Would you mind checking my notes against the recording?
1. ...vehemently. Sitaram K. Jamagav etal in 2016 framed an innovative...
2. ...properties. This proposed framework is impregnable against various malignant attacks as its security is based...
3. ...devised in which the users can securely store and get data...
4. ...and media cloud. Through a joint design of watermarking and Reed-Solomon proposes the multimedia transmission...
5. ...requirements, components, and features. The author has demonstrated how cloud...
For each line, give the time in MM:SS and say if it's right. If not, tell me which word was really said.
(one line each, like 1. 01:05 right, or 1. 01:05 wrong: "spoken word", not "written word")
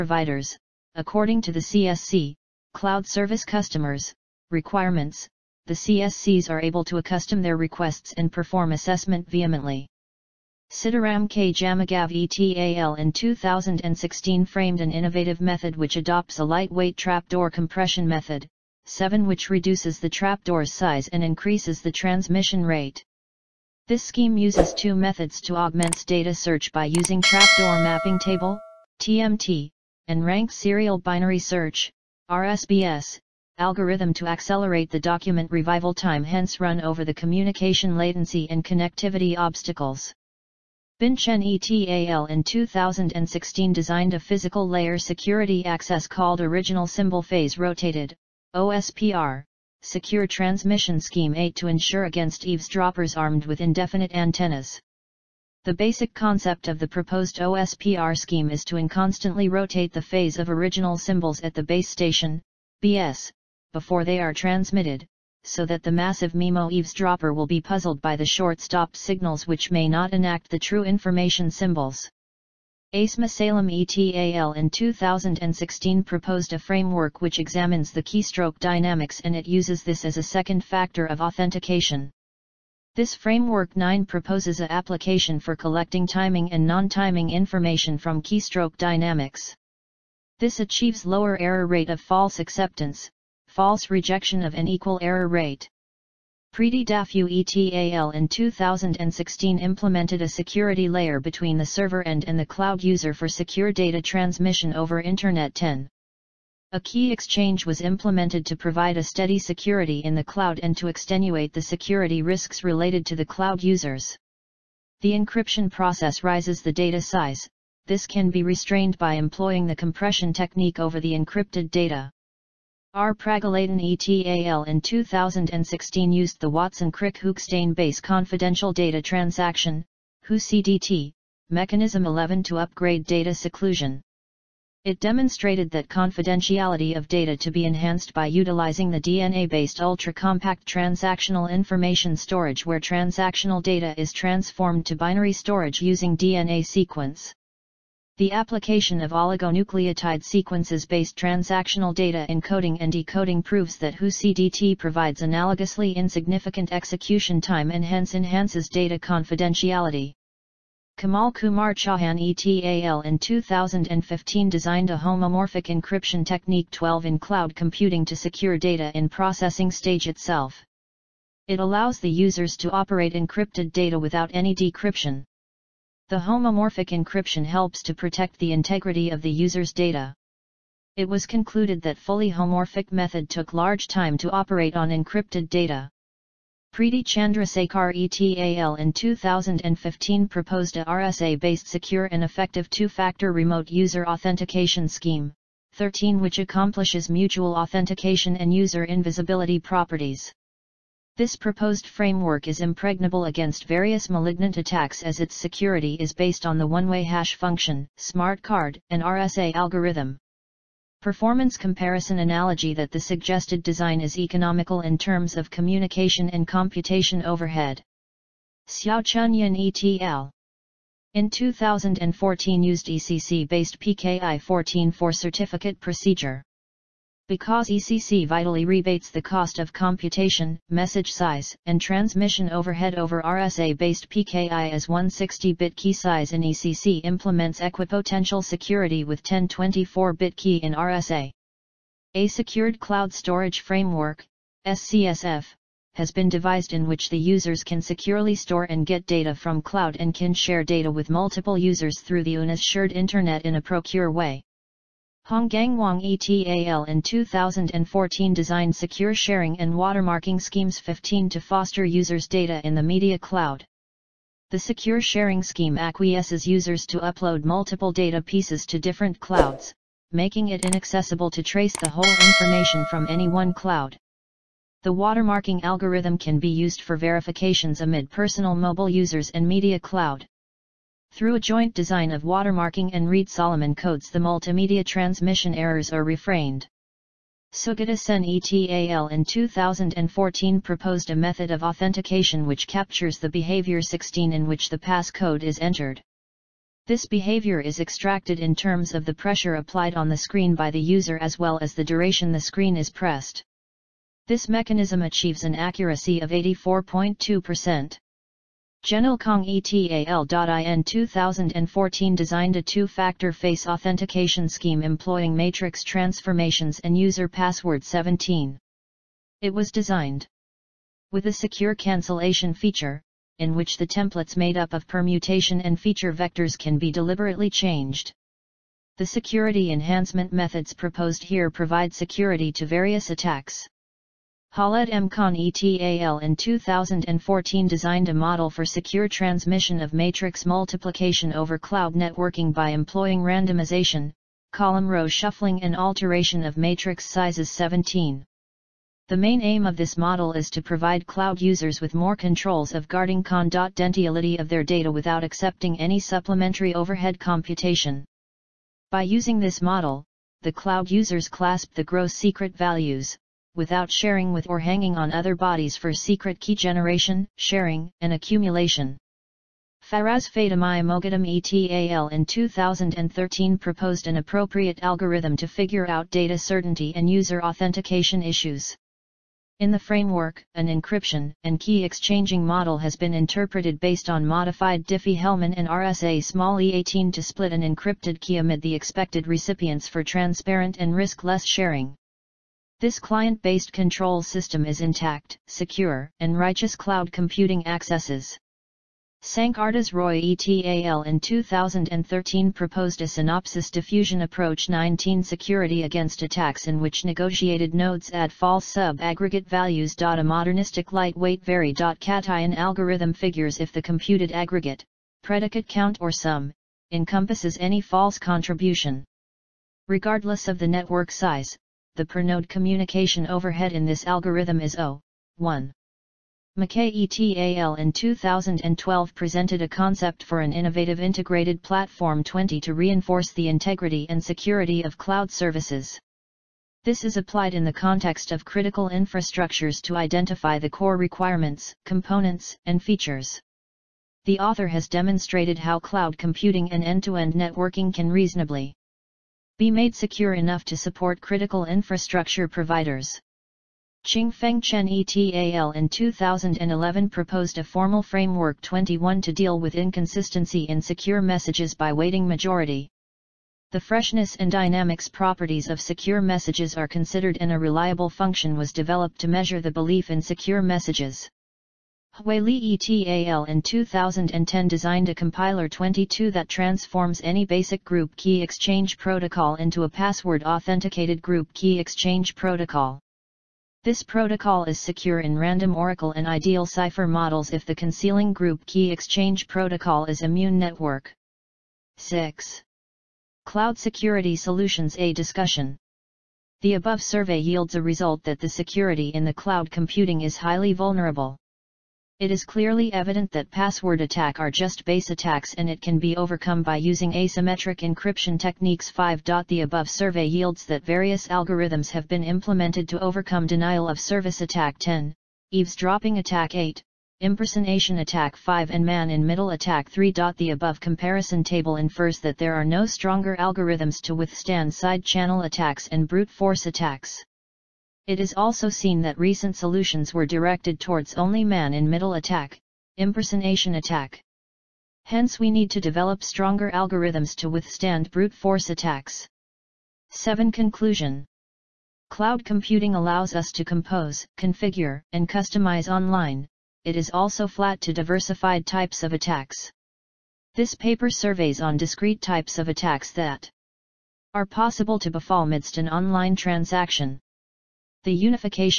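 1. 00:09 right
2. 03:19 right
3. 04:06 right
4. 04:39 wrong: "codes", not "proposes"
5. 07:20 right.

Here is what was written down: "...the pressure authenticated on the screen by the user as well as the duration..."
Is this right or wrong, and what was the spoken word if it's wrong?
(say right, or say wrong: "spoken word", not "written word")
wrong: "applied", not "authenticated".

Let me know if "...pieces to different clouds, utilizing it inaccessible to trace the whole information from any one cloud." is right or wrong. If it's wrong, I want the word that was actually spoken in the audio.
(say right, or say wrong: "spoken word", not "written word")
wrong: "making", not "utilizing".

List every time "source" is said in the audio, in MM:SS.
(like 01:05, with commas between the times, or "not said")
not said.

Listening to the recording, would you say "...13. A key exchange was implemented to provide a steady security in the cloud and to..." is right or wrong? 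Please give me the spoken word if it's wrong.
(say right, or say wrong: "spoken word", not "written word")
wrong: "10", not "13".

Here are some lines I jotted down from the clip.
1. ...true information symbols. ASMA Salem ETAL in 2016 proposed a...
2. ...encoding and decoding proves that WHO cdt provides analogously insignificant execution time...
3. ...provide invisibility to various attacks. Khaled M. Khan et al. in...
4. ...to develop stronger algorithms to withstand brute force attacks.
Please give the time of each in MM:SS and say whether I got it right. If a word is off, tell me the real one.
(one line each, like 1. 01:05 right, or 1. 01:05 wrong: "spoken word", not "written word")
1. 01:10 right
2. 02:32 right
3. 05:31 wrong: "security", not "invisibility"
4. 08:55 right.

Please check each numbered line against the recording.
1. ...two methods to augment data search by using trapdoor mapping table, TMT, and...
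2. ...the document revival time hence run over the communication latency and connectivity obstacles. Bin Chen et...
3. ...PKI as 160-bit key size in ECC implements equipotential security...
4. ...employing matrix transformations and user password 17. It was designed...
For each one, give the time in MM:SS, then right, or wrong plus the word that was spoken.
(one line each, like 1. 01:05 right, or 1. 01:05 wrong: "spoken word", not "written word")
1. 00:24 right
2. 00:34 right
3. 03:54 right
4. 05:14 right.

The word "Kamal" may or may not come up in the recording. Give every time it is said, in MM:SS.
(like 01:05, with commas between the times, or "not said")
02:40.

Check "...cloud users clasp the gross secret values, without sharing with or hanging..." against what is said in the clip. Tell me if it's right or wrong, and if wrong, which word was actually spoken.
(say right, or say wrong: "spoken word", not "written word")
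right.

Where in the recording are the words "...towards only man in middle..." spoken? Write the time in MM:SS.
08:50.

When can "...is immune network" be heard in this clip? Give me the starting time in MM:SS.
08:10.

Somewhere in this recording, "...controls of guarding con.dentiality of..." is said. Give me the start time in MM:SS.
05:52.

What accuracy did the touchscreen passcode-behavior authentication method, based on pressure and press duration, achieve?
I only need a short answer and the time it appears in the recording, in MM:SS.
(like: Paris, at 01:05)
84.2%, at 05:06.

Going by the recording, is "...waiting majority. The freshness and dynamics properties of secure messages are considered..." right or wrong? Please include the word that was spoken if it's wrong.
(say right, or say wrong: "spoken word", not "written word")
right.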